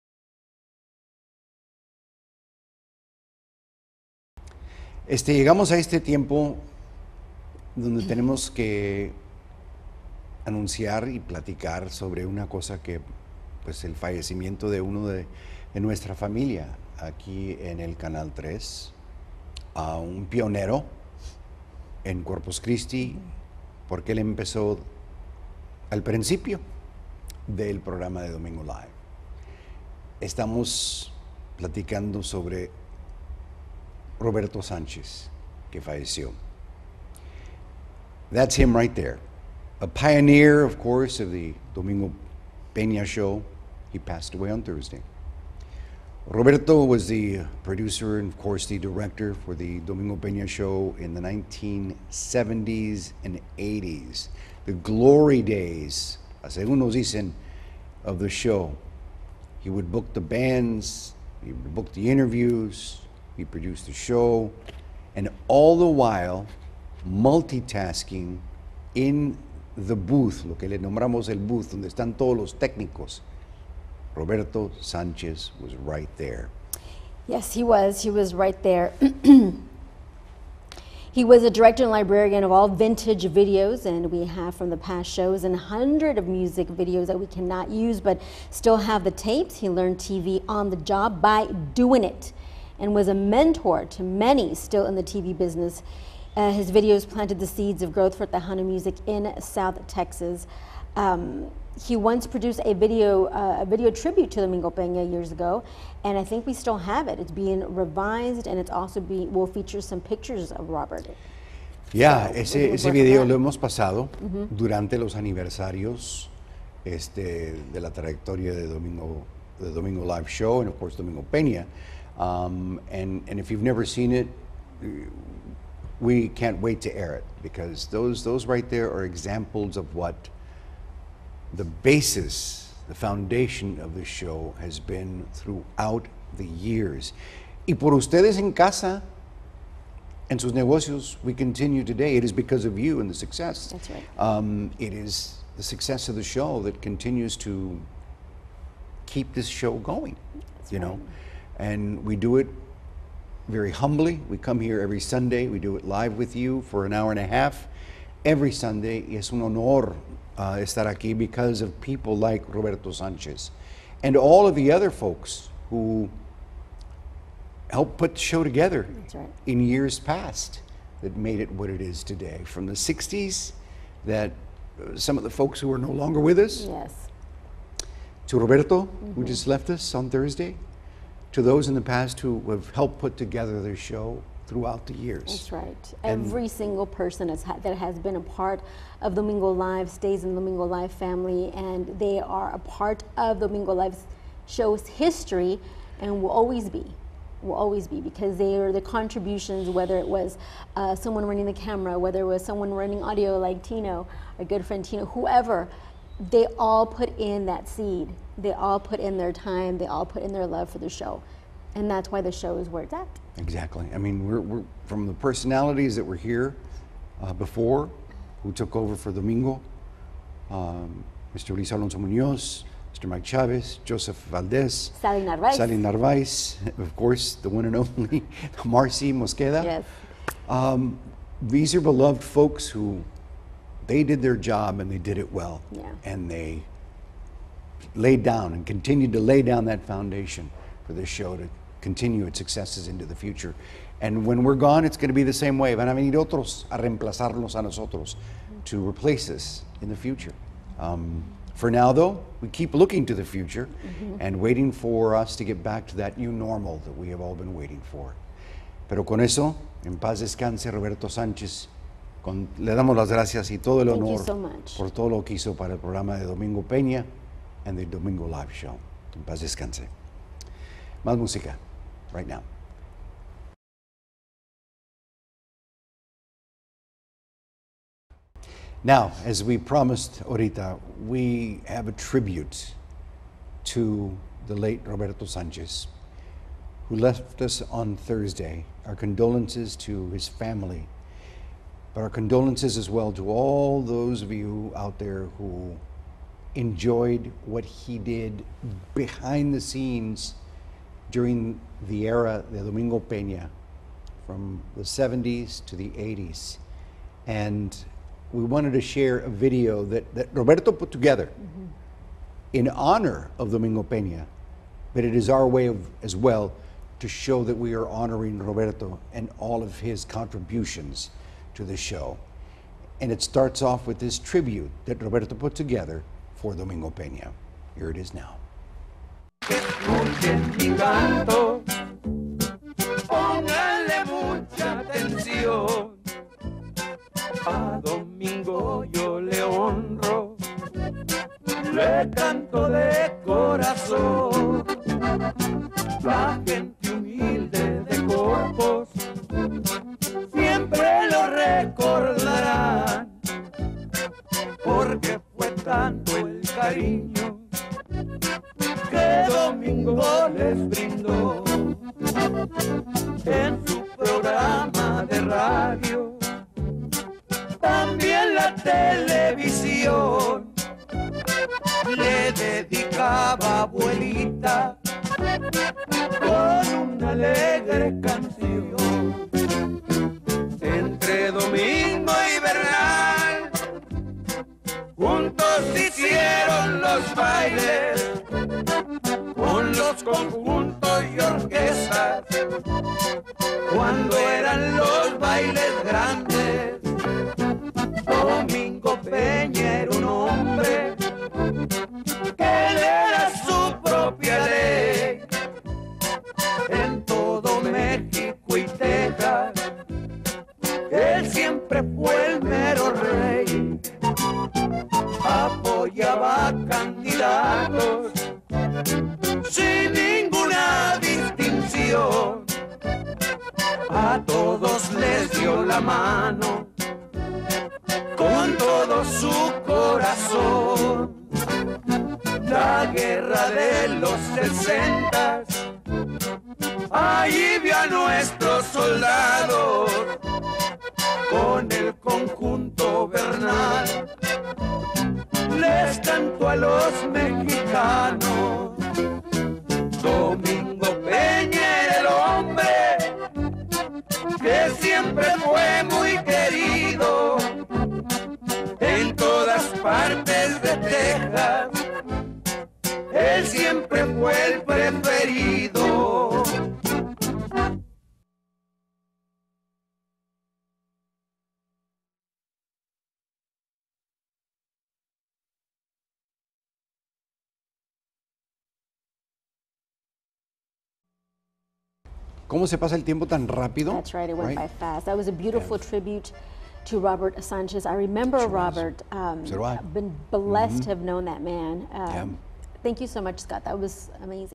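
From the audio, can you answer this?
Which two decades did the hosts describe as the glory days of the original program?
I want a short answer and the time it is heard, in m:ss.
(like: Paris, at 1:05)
1970s and 80s, at 0:51.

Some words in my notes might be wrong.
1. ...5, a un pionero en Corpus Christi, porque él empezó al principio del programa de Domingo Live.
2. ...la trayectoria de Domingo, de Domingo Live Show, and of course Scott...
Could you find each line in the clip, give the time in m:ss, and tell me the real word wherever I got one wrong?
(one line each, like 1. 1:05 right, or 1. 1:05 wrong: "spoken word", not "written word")
1. 0:18 wrong: "3", not "5"
2. 1:57 wrong: "Domingo", not "Scott".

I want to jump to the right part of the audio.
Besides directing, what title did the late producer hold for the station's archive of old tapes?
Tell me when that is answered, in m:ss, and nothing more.
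1:21.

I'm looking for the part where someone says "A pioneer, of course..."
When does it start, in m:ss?
0:39.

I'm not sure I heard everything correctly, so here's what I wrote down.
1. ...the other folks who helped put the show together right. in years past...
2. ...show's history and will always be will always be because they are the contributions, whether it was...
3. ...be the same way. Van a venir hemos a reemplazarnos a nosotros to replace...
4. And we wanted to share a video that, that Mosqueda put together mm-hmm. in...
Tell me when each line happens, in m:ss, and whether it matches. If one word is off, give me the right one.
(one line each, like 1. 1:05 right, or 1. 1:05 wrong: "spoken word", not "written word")
1. 2:44 right
2. 3:14 right
3. 4:05 wrong: "otros", not "hemos"
4. 5:07 wrong: "Roberto", not "Mosqueda".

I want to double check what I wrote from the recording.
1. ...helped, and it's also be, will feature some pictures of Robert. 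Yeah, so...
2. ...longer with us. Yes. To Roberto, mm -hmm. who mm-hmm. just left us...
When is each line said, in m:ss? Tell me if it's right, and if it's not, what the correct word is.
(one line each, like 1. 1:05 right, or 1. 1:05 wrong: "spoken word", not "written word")
1. 1:47 wrong: "revised", not "helped"
2. 2:55 right.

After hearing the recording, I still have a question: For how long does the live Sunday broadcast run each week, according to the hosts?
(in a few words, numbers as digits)
An hour and a half.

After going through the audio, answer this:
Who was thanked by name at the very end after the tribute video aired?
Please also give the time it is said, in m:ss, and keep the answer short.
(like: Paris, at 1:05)
Scott, at 8:13.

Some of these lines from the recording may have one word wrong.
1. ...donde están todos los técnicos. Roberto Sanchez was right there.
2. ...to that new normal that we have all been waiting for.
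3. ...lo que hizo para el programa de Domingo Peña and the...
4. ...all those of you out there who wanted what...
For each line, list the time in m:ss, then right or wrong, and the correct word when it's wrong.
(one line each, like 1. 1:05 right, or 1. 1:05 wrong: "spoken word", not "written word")
1. 1:11 right
2. 4:15 right
3. 4:25 right
4. 4:53 wrong: "enjoyed", not "wanted".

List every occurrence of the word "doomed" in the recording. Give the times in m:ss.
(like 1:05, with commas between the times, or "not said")
not said.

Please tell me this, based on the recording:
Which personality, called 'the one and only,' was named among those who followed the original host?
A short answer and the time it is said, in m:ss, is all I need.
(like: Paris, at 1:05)
Marcy Mosqueda, at 3:48.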